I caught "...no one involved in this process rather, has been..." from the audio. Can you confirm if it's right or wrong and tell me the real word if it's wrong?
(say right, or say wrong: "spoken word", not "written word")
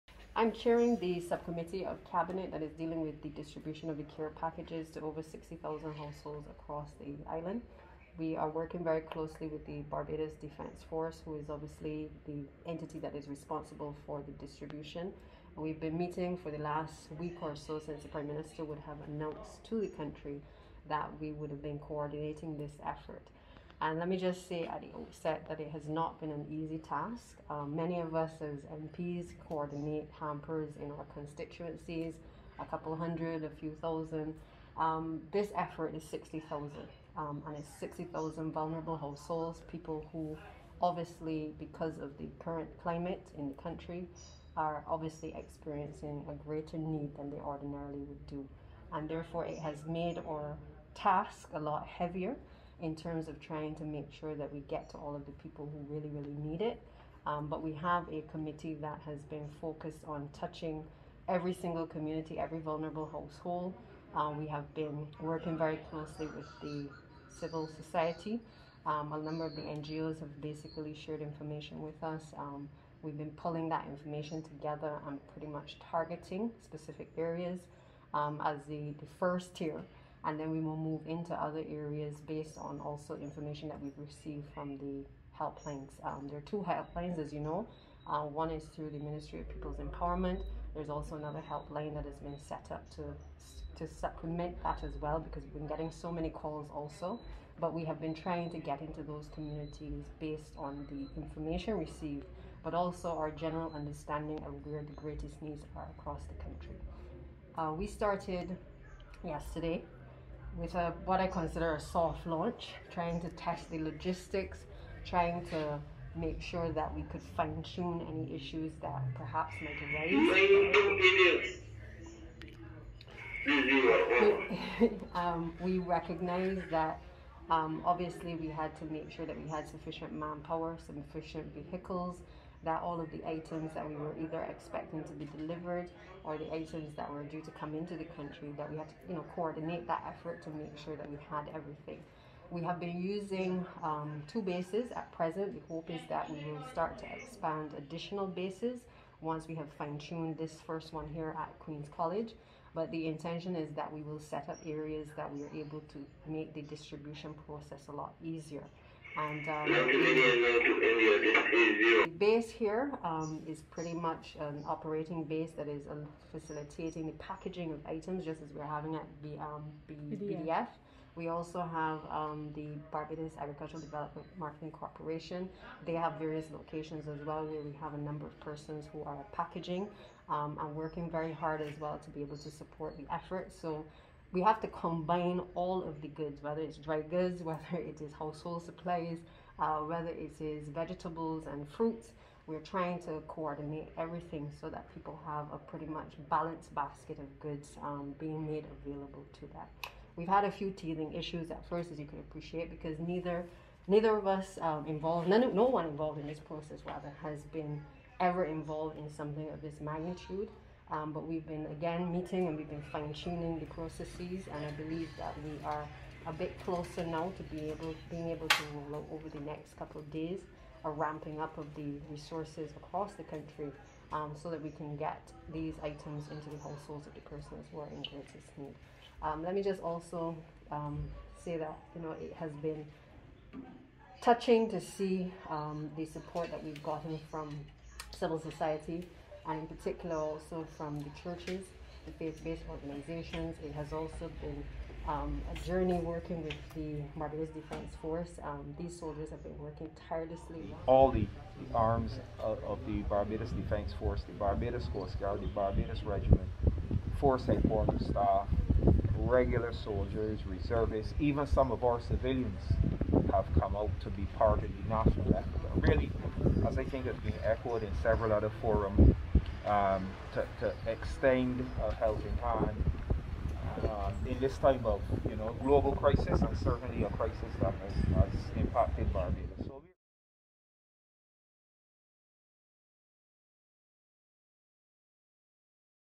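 right.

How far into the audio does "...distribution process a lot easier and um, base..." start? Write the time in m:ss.
2:36.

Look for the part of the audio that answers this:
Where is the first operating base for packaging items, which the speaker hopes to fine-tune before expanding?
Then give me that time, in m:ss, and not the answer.
2:31.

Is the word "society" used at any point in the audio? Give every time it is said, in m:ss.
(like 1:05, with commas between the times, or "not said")
1:07, 3:58.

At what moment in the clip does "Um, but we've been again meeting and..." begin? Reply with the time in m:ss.
3:30.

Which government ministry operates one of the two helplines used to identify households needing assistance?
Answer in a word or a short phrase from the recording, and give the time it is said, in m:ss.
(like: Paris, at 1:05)
Ministry of People's Empowerment, at 1:28.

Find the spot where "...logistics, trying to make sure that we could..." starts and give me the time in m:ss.
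1:53.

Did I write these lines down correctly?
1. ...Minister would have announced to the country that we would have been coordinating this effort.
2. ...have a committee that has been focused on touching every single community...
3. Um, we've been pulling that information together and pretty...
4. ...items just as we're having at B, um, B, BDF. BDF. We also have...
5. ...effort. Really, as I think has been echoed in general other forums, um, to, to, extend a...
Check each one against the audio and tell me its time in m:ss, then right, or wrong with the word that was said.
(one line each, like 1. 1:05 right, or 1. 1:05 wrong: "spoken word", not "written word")
1. 0:18 right
2. 0:57 right
3. 1:12 right
4. 2:47 right
5. 4:25 wrong: "several", not "general".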